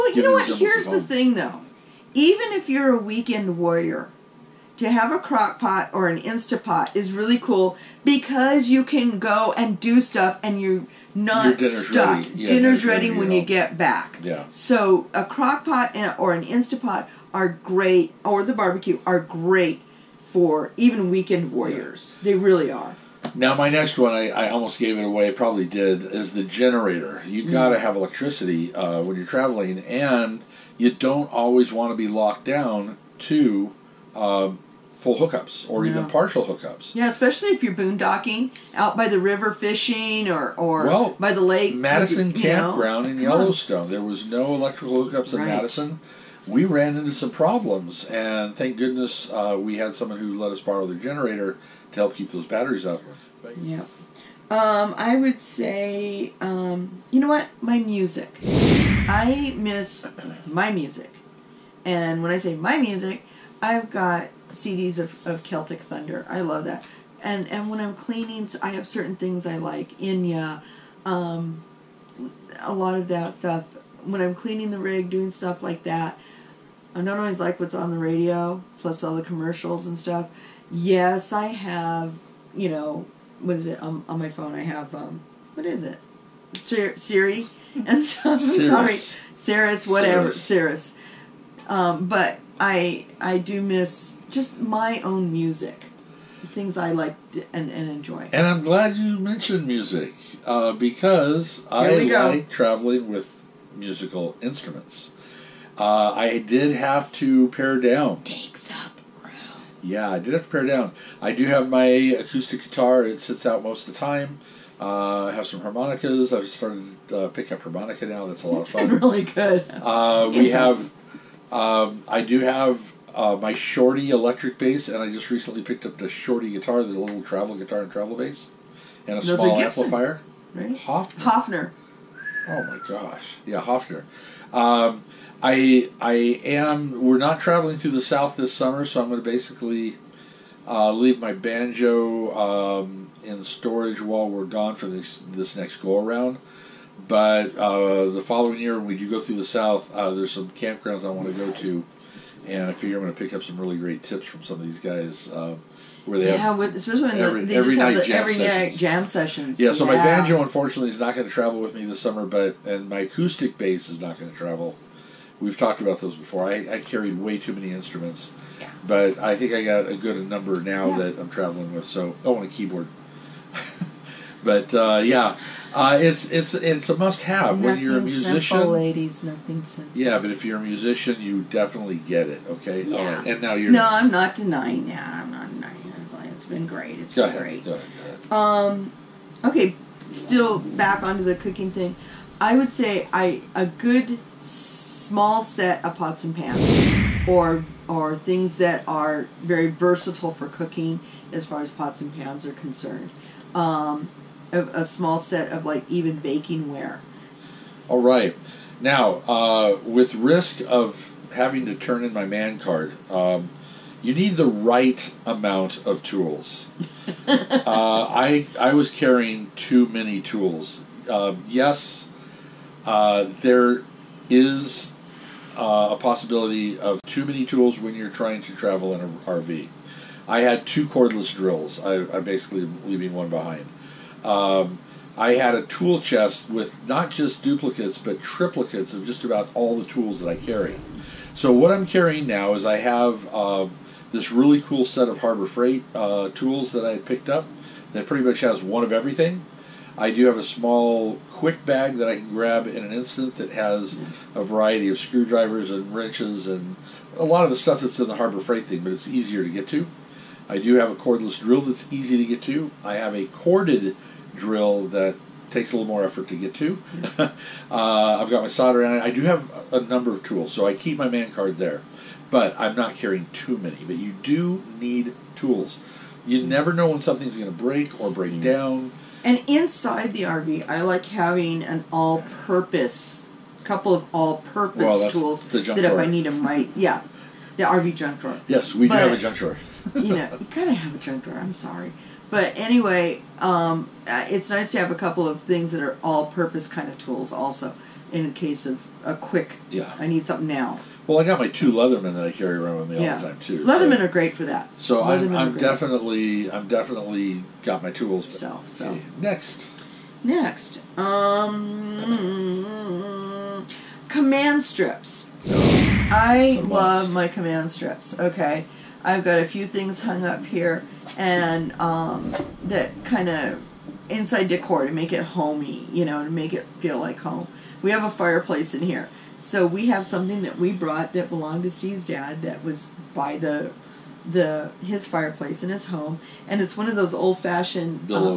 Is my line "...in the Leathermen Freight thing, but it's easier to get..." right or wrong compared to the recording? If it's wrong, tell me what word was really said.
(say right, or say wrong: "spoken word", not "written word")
wrong: "Harbor", not "Leathermen".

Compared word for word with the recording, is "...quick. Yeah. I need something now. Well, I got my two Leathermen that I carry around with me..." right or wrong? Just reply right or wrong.
right.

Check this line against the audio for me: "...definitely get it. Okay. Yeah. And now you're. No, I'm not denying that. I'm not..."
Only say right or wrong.
right.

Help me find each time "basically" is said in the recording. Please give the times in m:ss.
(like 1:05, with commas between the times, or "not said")
2:19, 3:52.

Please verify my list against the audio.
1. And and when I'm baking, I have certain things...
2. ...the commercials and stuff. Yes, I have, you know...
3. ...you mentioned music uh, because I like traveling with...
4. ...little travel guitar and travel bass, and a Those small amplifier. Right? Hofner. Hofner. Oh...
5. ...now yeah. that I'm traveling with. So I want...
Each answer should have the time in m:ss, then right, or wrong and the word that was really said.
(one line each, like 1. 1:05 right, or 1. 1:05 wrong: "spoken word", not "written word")
1. 1:07 wrong: "cleaning", not "baking"
2. 1:19 right
3. 1:38 right
4. 2:06 right
5. 2:50 right.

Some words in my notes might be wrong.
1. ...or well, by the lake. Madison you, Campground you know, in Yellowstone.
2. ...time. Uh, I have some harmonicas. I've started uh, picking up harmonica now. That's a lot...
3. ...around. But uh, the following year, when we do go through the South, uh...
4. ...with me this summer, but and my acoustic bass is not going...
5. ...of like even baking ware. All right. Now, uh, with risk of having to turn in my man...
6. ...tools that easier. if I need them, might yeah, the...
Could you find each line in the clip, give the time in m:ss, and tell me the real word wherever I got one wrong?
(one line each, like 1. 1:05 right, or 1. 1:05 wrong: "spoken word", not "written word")
1. 0:40 right
2. 1:53 right
3. 2:26 right
4. 2:41 right
5. 3:25 right
6. 4:45 wrong: "drawer", not "easier".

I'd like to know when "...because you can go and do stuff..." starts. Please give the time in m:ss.
0:08.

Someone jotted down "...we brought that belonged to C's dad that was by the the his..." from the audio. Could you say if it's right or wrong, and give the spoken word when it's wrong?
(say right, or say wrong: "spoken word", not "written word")
right.